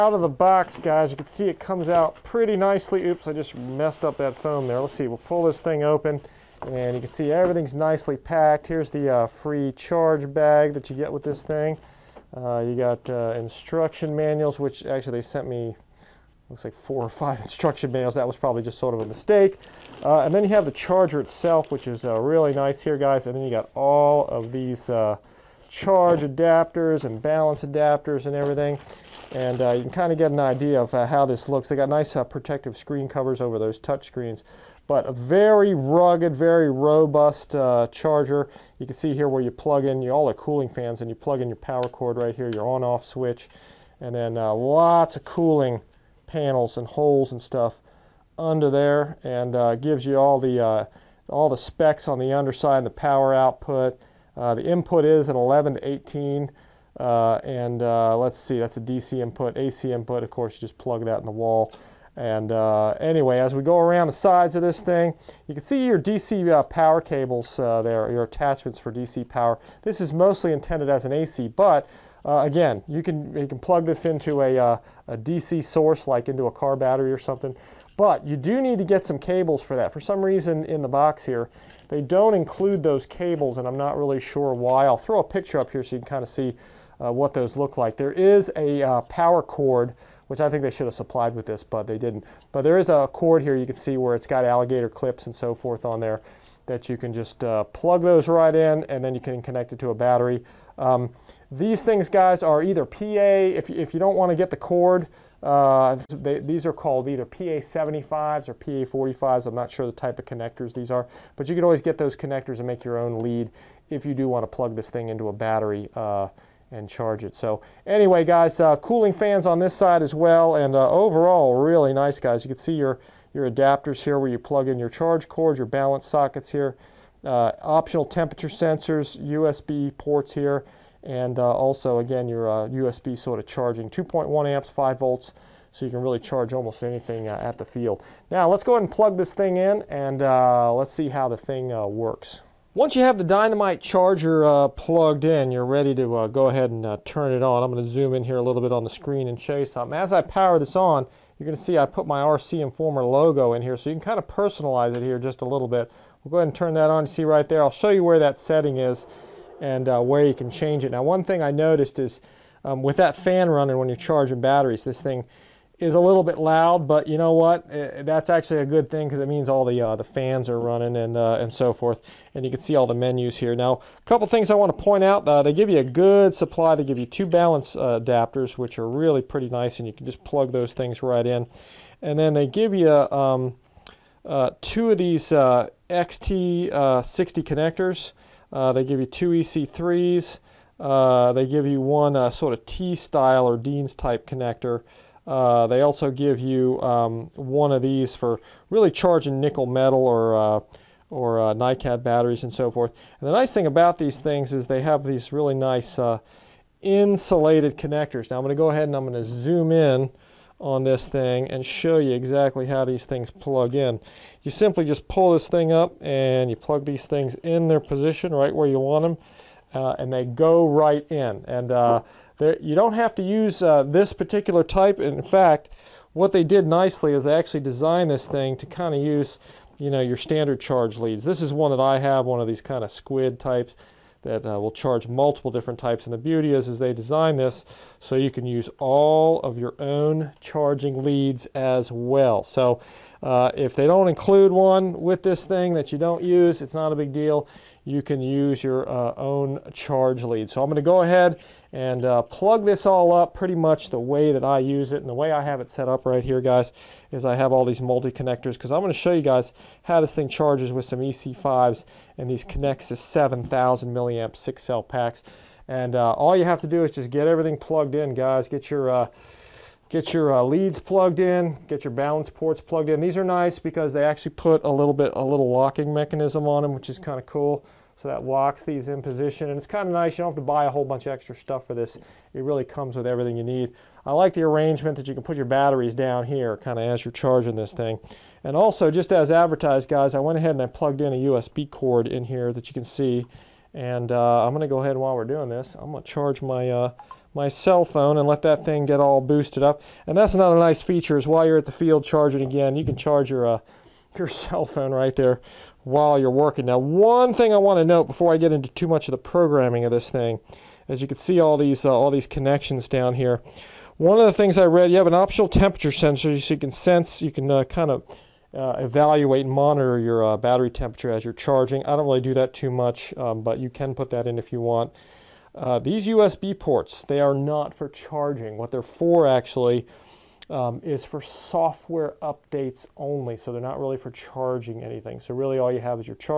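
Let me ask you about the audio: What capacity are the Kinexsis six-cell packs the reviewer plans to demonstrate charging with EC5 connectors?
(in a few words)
7000 milliamp.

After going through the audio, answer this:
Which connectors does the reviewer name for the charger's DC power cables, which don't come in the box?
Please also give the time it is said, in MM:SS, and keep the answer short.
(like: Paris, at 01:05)
PA75s or PA45s, at 01:47.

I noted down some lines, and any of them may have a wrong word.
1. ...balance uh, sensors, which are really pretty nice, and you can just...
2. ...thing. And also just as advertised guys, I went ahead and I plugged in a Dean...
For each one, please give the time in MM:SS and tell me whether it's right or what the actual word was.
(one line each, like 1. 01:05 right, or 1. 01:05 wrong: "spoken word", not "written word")
1. 02:57 wrong: "adapters", not "sensors"
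2. 04:47 wrong: "USB", not "Dean".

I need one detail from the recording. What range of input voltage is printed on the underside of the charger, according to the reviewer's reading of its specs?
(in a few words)
11 to 18.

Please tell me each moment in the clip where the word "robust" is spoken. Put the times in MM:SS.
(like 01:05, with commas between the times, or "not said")
00:36.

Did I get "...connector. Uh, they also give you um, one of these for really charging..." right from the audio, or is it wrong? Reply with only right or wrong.
right.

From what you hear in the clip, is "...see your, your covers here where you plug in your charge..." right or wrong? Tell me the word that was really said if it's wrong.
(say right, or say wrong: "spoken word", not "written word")
wrong: "adapters", not "covers".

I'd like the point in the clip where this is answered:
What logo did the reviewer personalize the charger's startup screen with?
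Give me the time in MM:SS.
02:32.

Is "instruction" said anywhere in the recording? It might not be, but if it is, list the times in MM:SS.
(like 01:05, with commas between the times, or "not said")
00:13, 00:17.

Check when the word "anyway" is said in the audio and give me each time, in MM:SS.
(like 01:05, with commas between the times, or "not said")
01:03, 01:57.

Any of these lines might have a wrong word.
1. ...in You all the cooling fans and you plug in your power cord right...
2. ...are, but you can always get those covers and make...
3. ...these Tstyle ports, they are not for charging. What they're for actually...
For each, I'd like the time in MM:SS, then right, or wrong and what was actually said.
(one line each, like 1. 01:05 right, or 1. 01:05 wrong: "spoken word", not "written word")
1. 00:39 right
2. 01:50 wrong: "connectors", not "covers"
3. 05:25 wrong: "USB", not "Tstyle".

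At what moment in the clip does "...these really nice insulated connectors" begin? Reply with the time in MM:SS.
03:25.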